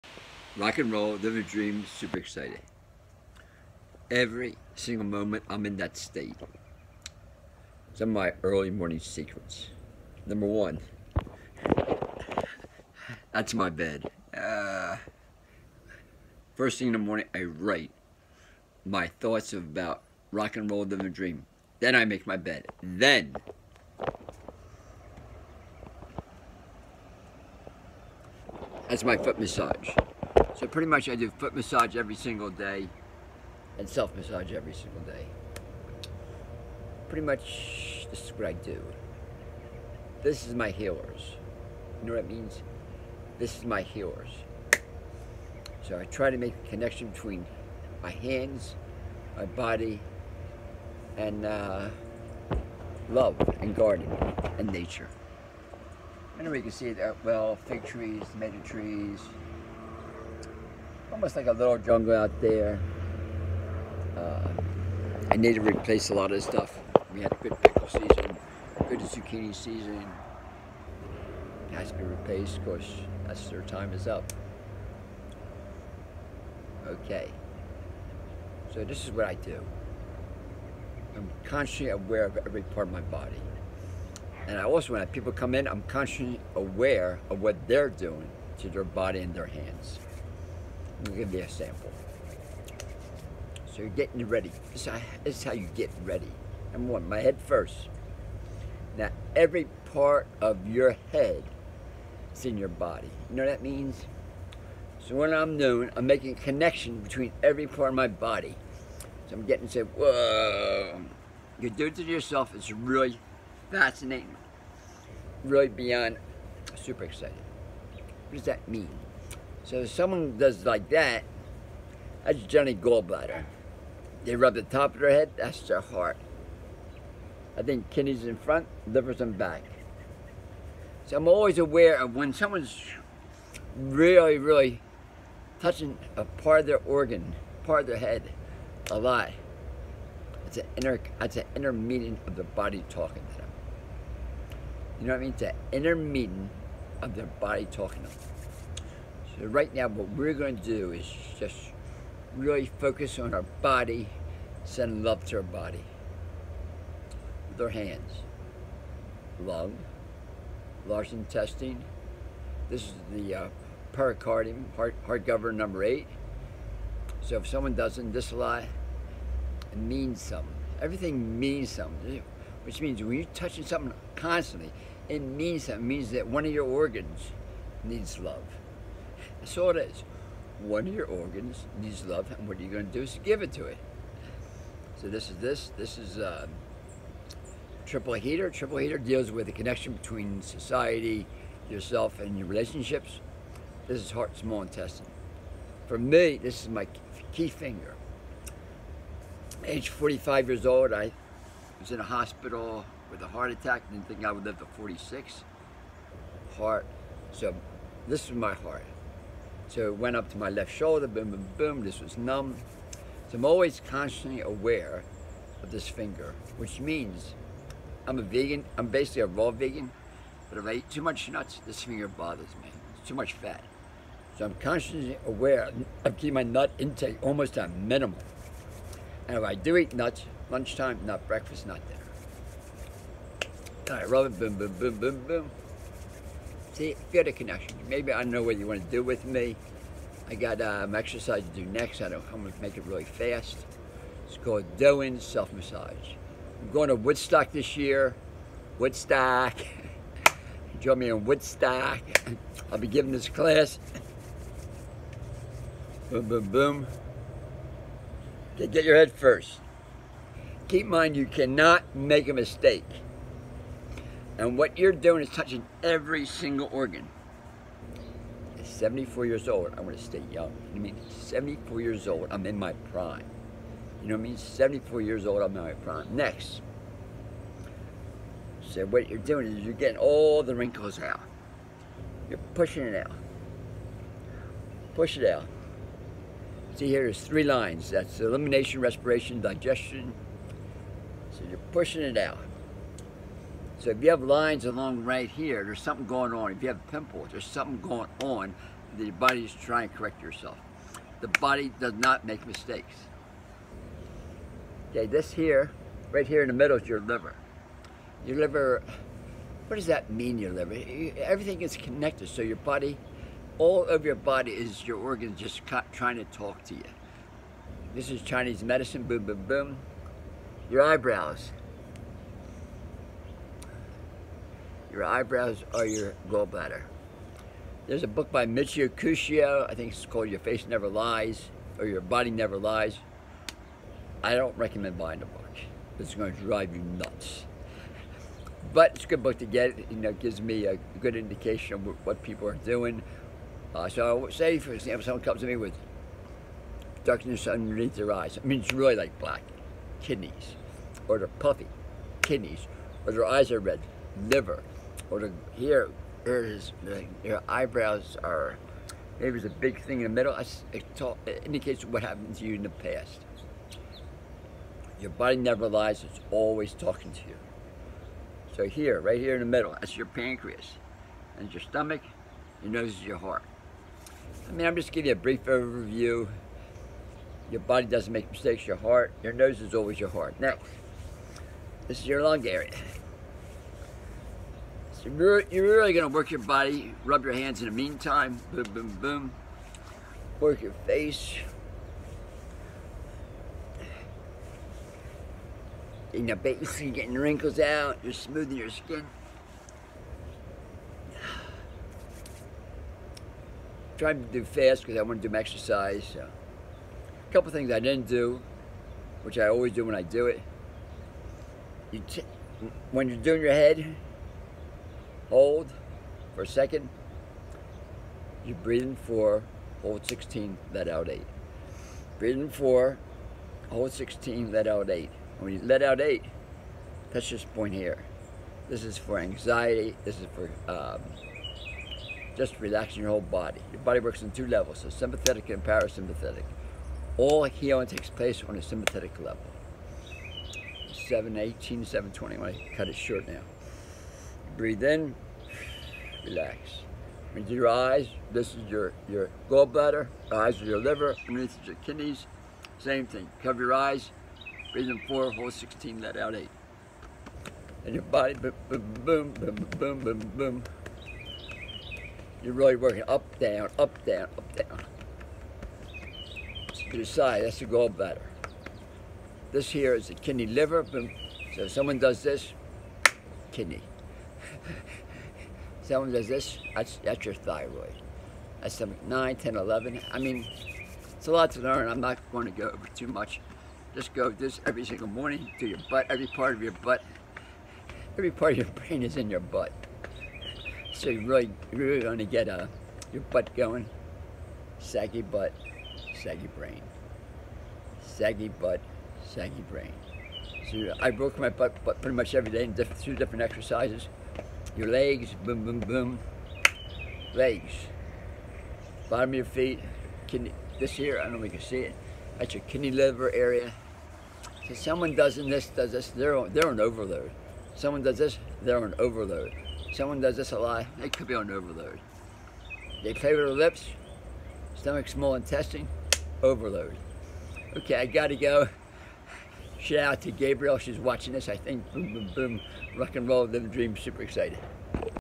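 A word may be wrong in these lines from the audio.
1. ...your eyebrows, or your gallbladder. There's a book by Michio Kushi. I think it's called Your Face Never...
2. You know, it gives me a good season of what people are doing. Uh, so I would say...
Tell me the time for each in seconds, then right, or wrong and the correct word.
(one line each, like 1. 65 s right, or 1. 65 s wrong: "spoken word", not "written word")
1. 324 s right
2. 339 s wrong: "indication", not "season".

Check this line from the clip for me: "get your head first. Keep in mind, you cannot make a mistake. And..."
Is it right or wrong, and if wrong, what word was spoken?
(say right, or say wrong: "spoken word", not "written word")
right.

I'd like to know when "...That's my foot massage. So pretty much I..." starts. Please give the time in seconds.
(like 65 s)
28 s.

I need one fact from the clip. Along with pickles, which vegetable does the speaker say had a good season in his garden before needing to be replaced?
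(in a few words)
Zucchini.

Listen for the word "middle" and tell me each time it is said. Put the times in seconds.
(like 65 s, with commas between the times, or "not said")
306 s, 360 s, 369 s.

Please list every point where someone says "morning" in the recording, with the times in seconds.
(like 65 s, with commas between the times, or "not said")
8 s, 16 s, 485 s.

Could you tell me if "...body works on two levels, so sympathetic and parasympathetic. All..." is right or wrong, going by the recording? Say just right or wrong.
right.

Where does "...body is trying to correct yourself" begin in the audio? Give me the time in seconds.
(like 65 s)
299 s.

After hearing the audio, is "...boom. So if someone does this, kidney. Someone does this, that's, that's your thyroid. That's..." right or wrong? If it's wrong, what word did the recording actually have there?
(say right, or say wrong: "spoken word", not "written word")
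right.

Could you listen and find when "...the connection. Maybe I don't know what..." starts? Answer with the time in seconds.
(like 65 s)
237 s.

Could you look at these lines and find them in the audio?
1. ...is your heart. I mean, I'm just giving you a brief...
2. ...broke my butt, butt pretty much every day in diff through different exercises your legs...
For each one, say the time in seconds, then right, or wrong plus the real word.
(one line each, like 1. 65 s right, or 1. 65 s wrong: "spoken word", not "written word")
1. 372 s right
2. 501 s right.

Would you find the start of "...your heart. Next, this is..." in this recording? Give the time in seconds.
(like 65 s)
379 s.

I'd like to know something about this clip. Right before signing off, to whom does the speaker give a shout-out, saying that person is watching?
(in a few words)
Gabriel.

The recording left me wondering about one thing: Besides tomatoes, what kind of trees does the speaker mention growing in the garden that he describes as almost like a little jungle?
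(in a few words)
Fig.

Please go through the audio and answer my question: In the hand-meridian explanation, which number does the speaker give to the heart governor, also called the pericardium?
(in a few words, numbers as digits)
8.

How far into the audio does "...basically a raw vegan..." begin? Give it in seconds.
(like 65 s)
218 s.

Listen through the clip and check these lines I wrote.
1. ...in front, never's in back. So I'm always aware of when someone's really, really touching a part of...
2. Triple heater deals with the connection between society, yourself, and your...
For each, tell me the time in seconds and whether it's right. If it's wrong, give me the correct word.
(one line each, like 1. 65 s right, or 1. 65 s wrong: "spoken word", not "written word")
1. 128 s wrong: "liver", not "never"
2. 188 s right.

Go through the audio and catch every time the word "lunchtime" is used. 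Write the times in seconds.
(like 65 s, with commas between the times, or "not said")
230 s.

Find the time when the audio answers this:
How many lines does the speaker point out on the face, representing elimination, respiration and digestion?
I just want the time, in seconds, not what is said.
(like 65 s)
287 s.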